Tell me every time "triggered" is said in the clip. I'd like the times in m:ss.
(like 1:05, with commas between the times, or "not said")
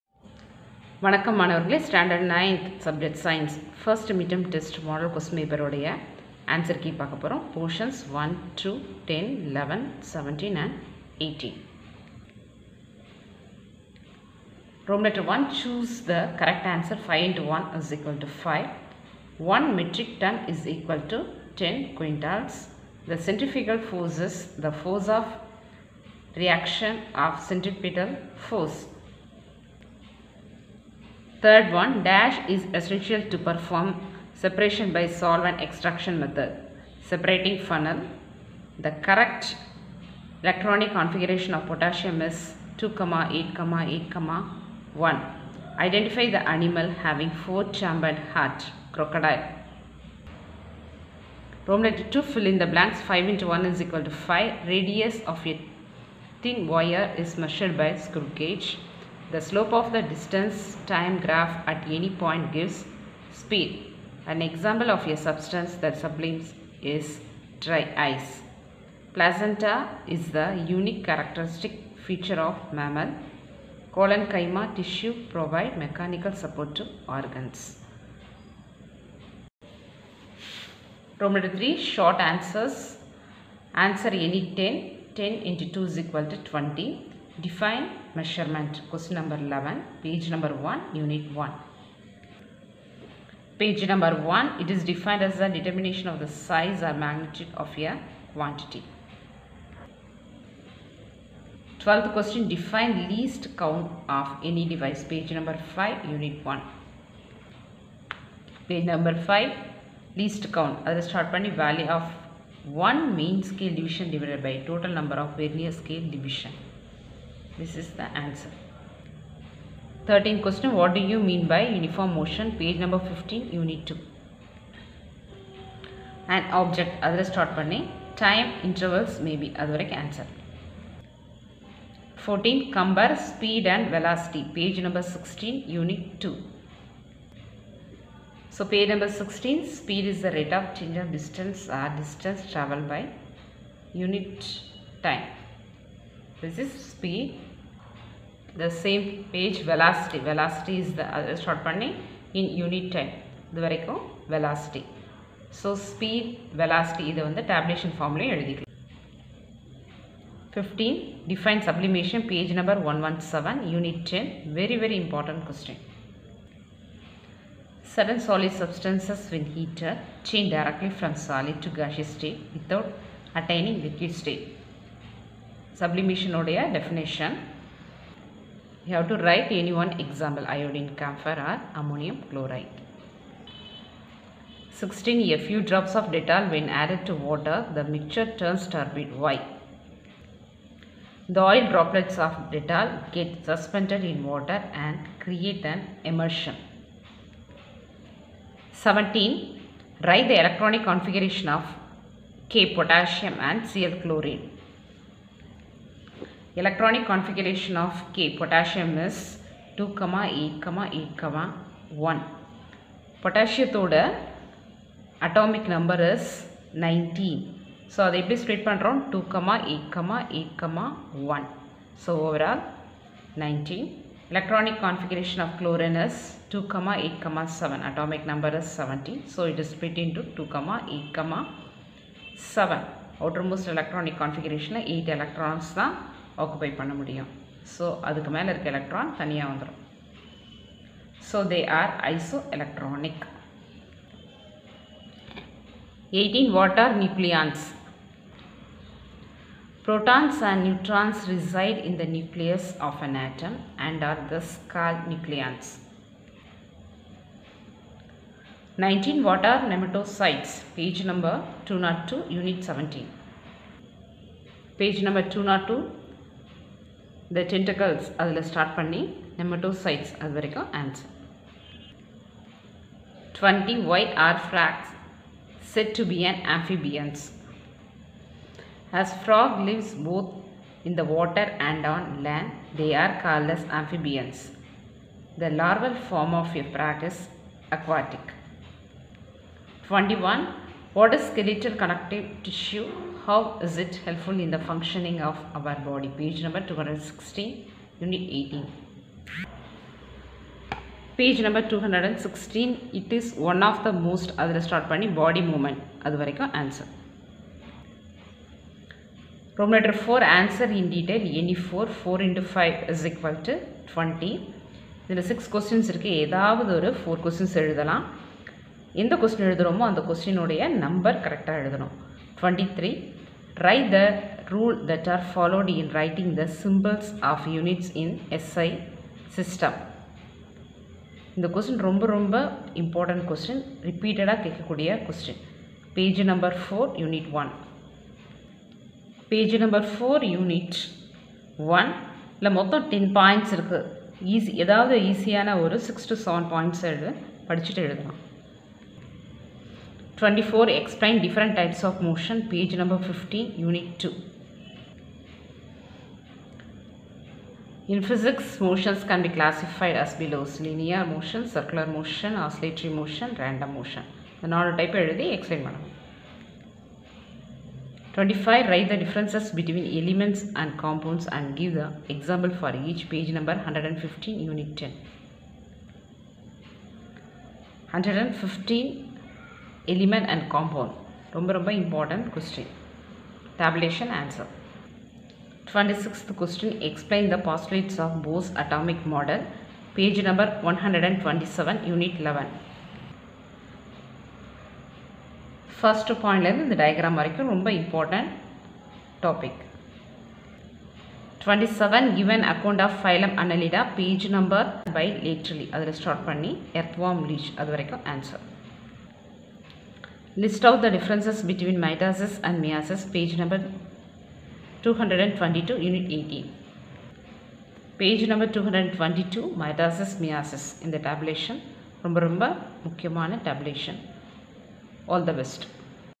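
not said.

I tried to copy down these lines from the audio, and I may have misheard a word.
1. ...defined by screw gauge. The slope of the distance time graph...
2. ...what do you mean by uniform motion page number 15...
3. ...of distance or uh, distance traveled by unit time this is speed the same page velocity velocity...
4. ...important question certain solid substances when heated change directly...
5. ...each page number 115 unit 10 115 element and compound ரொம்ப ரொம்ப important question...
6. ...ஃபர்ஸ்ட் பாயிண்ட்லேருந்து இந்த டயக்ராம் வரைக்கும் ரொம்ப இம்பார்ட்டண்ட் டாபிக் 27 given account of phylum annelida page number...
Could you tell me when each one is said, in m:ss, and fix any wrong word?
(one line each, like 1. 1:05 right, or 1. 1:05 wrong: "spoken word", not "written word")
1. 0:57 wrong: "measured", not "defined"
2. 2:00 right
3. 2:21 right
4. 2:45 right
5. 6:12 right
6. 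6:35 right.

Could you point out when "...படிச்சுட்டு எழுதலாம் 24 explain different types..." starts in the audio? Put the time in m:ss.
5:47.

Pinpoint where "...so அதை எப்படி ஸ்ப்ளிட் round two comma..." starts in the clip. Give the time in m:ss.
3:37.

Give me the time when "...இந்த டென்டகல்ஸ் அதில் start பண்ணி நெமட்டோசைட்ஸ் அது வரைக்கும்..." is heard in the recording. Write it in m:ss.
4:27.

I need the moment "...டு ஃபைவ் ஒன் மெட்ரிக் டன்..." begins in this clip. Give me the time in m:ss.
0:18.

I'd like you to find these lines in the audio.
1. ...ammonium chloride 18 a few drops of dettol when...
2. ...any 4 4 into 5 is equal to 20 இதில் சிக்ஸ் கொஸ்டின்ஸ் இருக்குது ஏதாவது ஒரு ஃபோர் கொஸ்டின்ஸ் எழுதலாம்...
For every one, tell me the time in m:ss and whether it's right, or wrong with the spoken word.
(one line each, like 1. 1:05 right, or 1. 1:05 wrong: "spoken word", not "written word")
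1. 3:01 wrong: "16", not "18"
2. 5:11 right.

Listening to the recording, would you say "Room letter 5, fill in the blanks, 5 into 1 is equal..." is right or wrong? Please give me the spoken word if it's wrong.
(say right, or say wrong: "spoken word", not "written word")
wrong: "2", not "5".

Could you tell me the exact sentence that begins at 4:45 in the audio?
The larval form of a frog is aquatic.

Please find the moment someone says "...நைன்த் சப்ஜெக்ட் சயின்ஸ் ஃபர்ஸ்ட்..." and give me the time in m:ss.
0:02.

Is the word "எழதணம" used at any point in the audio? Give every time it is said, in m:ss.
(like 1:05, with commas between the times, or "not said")
5:21.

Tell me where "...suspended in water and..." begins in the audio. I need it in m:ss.
3:13.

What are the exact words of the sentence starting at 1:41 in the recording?
12th question, define least count of any device.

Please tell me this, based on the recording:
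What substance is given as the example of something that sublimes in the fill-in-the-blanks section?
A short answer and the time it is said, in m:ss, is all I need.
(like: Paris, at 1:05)
Dry ice, at 1:07.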